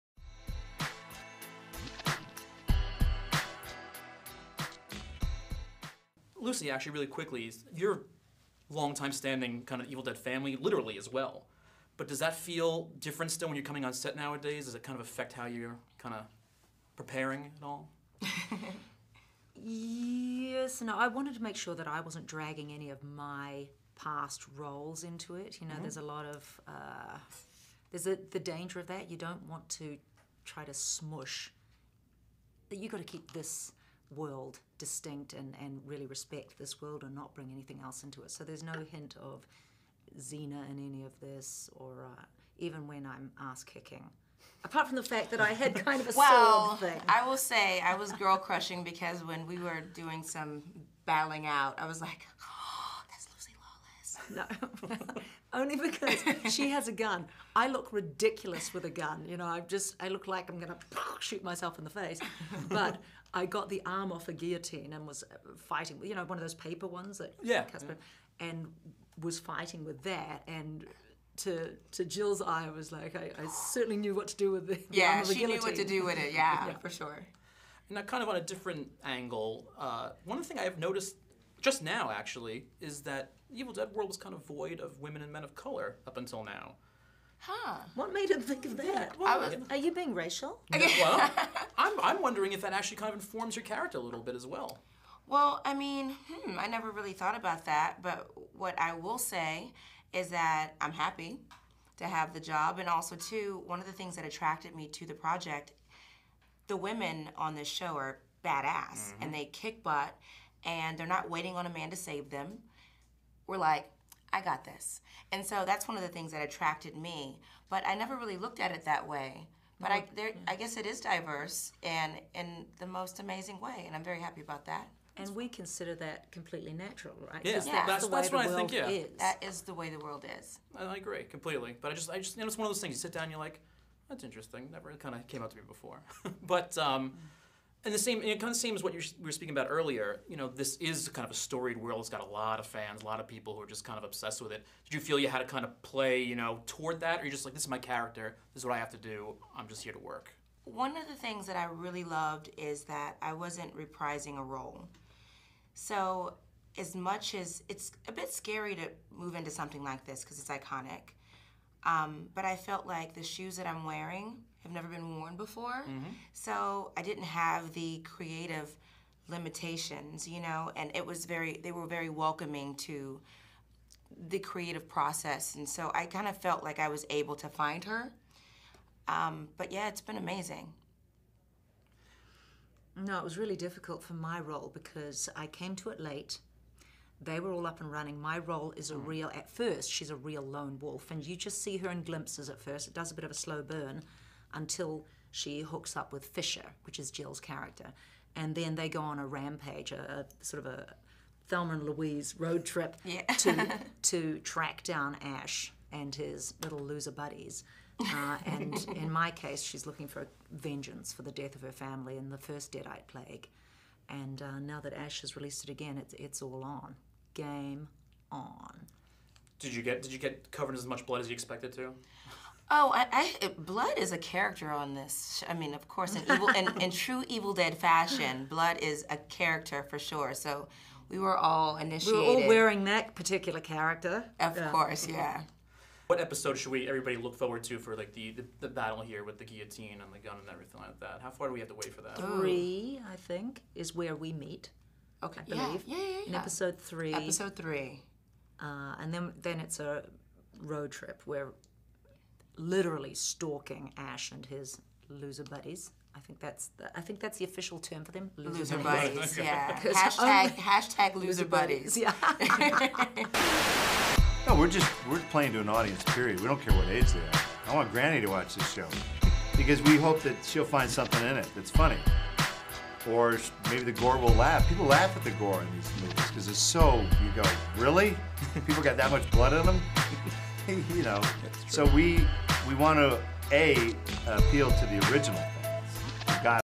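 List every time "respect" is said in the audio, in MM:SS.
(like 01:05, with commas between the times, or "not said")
00:36.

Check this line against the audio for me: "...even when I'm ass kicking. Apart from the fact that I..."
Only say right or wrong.
right.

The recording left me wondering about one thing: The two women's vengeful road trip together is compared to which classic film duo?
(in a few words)
Thelma and Louise.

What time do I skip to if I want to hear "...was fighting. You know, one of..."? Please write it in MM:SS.
01:05.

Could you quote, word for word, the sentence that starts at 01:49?
and they kick butt and they're not waiting on a man to save them.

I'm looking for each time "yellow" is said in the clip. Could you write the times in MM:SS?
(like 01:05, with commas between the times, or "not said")
not said.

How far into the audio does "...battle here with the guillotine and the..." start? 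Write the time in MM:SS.
03:58.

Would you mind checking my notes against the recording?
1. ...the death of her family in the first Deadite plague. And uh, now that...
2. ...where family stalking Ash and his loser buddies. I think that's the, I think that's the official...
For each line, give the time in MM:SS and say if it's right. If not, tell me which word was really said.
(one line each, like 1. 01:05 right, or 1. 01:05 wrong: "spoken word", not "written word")
1. 03:31 right
2. 04:11 wrong: "literally", not "family".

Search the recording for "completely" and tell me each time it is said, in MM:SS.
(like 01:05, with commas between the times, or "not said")
02:06, 02:11.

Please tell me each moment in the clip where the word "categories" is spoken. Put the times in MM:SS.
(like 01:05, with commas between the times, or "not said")
not said.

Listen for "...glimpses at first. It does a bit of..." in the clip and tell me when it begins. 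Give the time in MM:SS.
03:12.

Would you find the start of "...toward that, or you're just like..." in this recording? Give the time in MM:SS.
02:26.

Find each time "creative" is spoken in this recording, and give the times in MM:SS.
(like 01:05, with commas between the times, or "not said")
02:47, 02:54.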